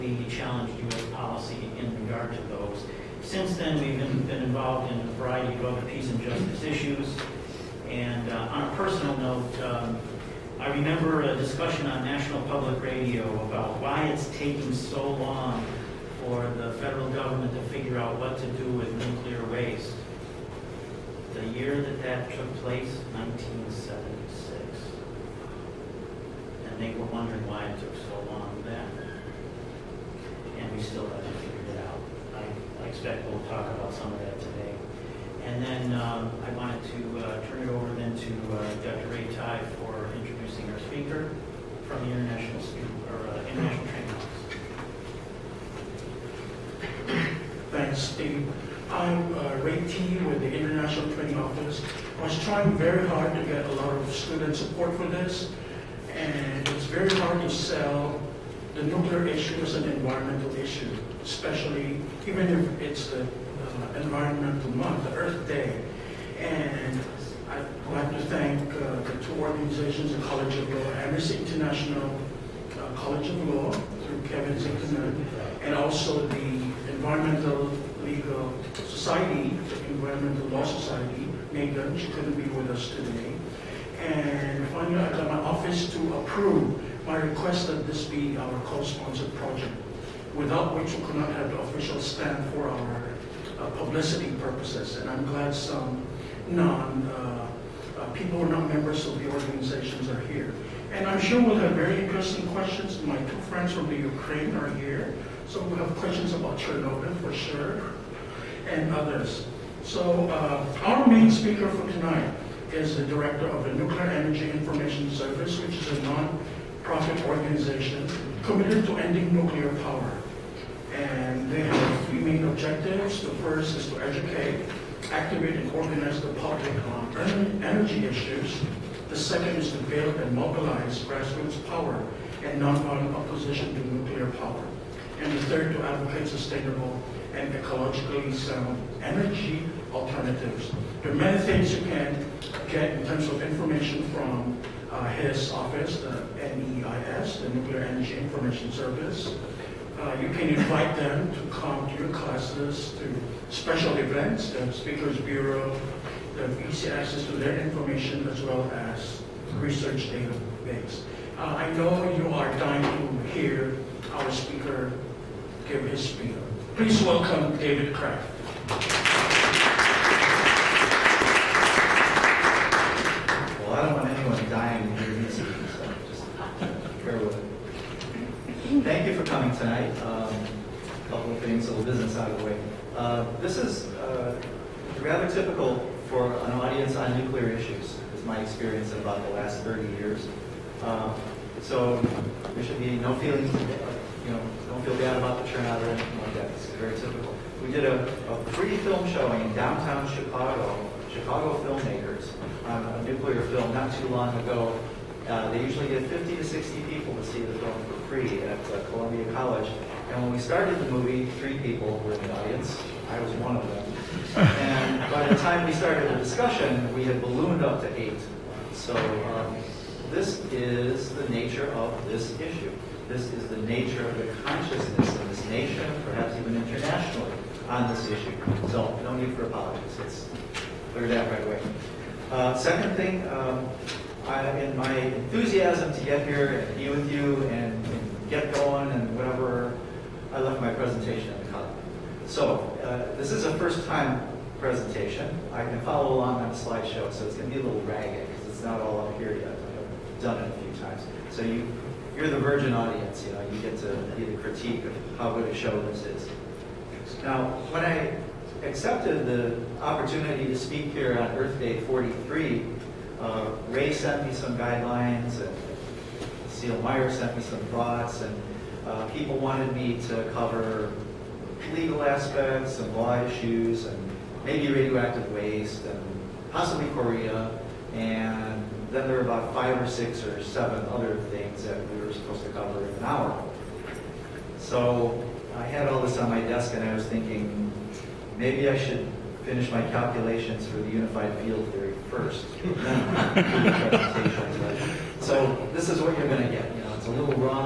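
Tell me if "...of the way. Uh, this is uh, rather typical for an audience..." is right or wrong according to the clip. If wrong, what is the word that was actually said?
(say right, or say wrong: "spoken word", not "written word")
right.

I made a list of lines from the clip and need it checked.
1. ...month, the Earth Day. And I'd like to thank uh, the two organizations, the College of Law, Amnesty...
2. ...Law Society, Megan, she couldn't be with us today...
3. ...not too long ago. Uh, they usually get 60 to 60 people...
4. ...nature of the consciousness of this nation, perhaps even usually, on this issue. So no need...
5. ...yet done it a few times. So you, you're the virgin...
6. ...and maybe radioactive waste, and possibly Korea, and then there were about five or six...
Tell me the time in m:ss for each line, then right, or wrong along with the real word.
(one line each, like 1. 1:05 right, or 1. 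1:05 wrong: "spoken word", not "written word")
1. 1:04 right
2. 1:20 right
3. 3:23 wrong: "50", not "60"
4. 3:43 wrong: "internationally", not "usually"
5. 4:09 right
6. 4:33 right.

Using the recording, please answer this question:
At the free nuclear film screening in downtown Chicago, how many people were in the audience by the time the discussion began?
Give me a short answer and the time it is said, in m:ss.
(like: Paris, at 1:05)
8, at 3:38.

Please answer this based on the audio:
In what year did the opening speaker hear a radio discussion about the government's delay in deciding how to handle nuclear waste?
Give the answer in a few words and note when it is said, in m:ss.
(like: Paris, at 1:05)
1976, at 0:23.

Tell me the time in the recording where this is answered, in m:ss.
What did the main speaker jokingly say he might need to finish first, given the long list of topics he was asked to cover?
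4:50.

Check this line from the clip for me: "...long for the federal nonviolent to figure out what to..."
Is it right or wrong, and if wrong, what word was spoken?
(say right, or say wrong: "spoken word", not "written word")
wrong: "government", not "nonviolent".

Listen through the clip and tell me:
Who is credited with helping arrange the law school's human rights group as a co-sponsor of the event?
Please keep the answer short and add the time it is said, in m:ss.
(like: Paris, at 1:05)
Kevin Zinkman, at 1:14.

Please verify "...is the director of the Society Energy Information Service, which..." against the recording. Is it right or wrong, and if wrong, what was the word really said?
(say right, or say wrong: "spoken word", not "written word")
wrong: "Nuclear", not "Society".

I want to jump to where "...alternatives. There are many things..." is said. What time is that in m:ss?
2:19.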